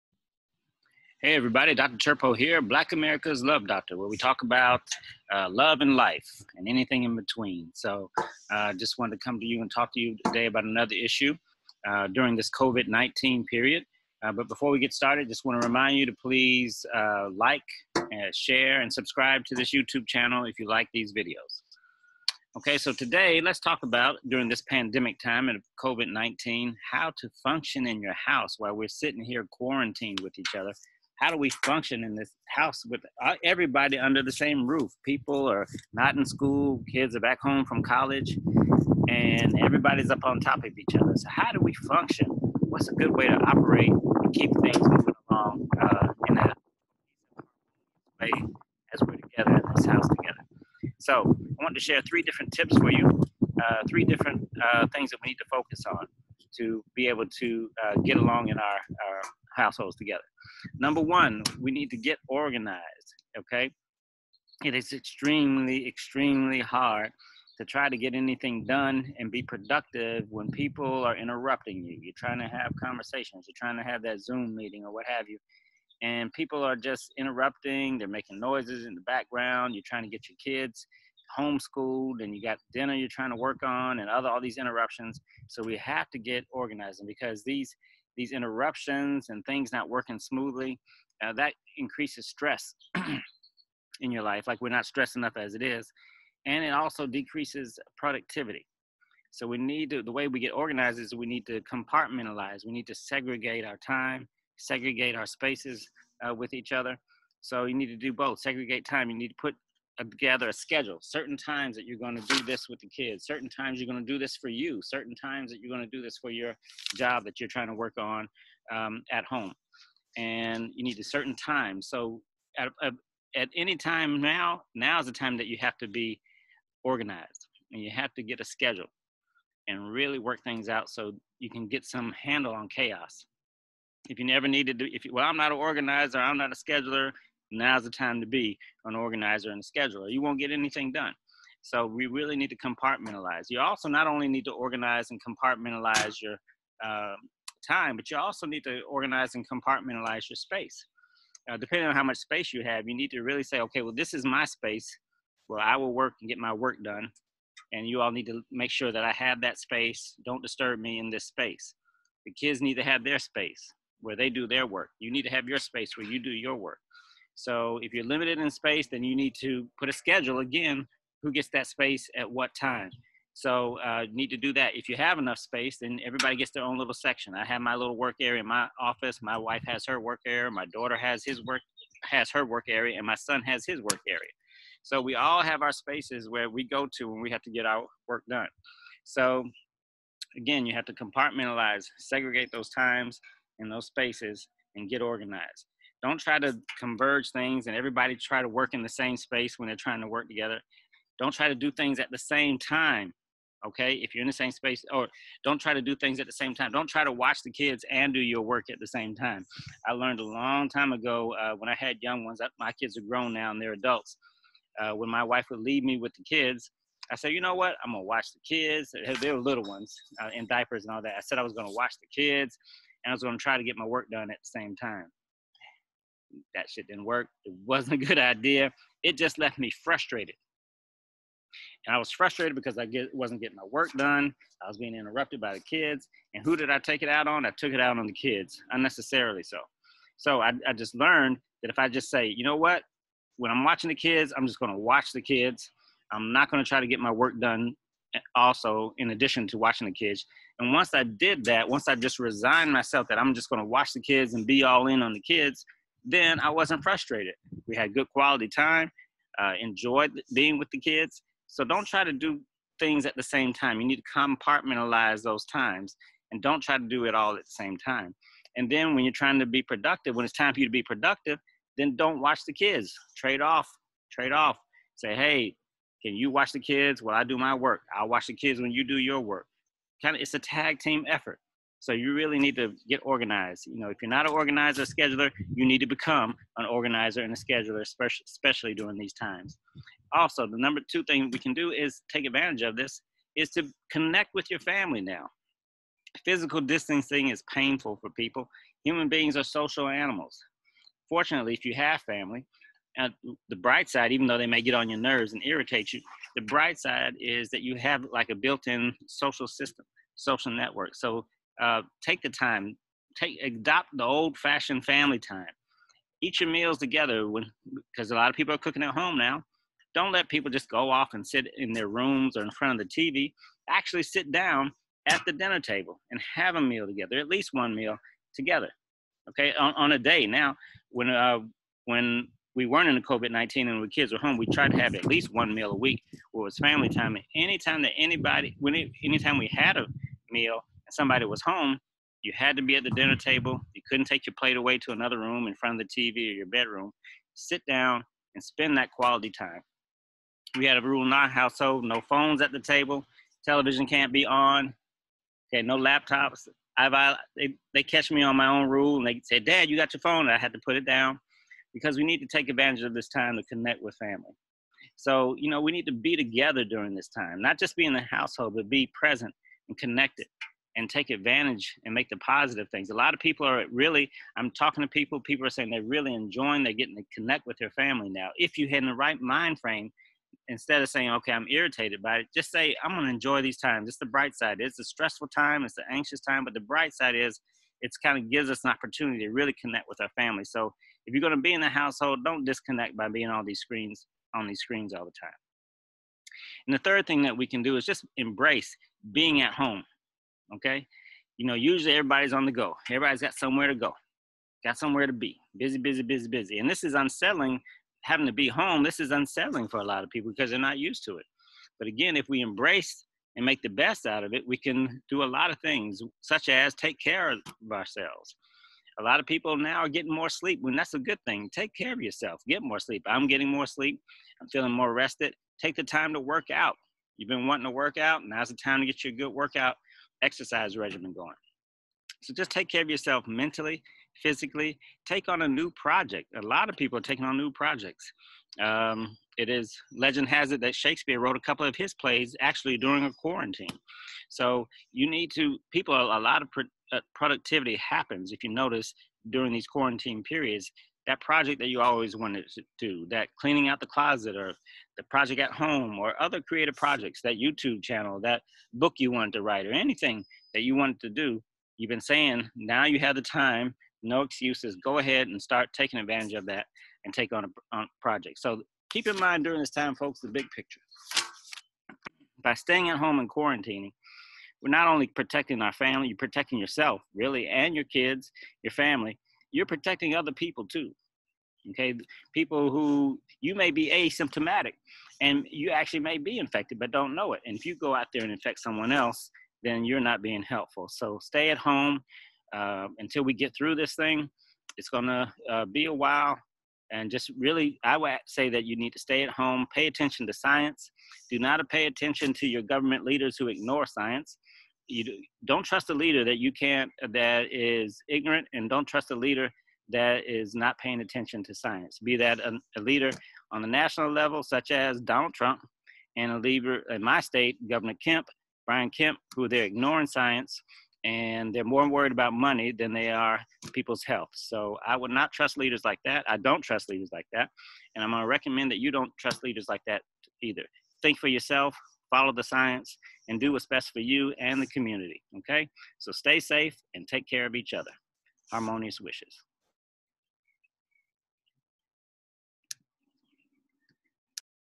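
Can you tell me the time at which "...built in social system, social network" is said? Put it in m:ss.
5:08.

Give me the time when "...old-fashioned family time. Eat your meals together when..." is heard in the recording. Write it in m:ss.
5:14.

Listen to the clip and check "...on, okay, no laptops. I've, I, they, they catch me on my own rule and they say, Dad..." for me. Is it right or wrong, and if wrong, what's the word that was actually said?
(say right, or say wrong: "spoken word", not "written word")
right.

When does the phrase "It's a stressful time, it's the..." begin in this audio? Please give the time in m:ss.
6:24.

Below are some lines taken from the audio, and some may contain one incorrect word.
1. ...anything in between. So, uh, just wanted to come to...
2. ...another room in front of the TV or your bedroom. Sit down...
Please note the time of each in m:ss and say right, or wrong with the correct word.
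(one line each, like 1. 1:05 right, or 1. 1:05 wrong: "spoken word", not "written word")
1. 0:06 right
2. 5:44 right.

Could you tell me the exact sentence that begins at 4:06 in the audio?
I'm not going to try to get my work done eh, also in addition to watching the kids.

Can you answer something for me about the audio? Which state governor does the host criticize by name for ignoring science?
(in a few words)
Brian Kemp.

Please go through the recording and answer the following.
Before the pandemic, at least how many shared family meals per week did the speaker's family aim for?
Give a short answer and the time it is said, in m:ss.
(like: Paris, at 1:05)
1, at 5:35.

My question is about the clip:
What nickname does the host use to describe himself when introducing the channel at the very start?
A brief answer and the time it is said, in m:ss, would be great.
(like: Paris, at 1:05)
Black America's Love Doctor, at 0:02.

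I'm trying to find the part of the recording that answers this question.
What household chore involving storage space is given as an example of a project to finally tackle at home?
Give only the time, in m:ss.
7:33.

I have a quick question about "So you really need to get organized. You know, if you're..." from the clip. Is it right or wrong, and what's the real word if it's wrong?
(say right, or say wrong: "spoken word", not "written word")
right.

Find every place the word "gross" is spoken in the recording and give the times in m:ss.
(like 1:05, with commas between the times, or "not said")
not said.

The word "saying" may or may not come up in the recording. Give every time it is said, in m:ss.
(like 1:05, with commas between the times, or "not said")
6:15, 6:20, 7:42.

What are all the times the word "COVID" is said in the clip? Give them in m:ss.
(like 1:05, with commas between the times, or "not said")
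0:12, 0:25, 5:33.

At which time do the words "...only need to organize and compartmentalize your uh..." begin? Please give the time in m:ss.
2:24.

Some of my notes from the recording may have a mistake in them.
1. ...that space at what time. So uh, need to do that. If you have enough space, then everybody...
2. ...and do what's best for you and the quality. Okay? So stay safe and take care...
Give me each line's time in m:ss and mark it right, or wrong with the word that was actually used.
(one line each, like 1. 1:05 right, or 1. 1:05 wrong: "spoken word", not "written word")
1. 2:51 right
2. 8:53 wrong: "community", not "quality".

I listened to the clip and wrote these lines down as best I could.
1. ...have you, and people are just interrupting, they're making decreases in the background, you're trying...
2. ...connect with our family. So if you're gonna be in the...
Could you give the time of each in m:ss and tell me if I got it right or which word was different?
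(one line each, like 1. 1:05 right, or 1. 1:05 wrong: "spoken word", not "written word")
1. 1:15 wrong: "noises", not "decreases"
2. 6:29 right.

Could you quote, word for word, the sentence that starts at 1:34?
Like we're not stressed enough as it is.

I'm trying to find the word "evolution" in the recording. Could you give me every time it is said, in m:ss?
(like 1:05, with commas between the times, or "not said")
not said.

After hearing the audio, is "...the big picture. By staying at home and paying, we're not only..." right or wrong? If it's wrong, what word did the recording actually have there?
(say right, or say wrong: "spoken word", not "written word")
wrong: "quarantining", not "paying".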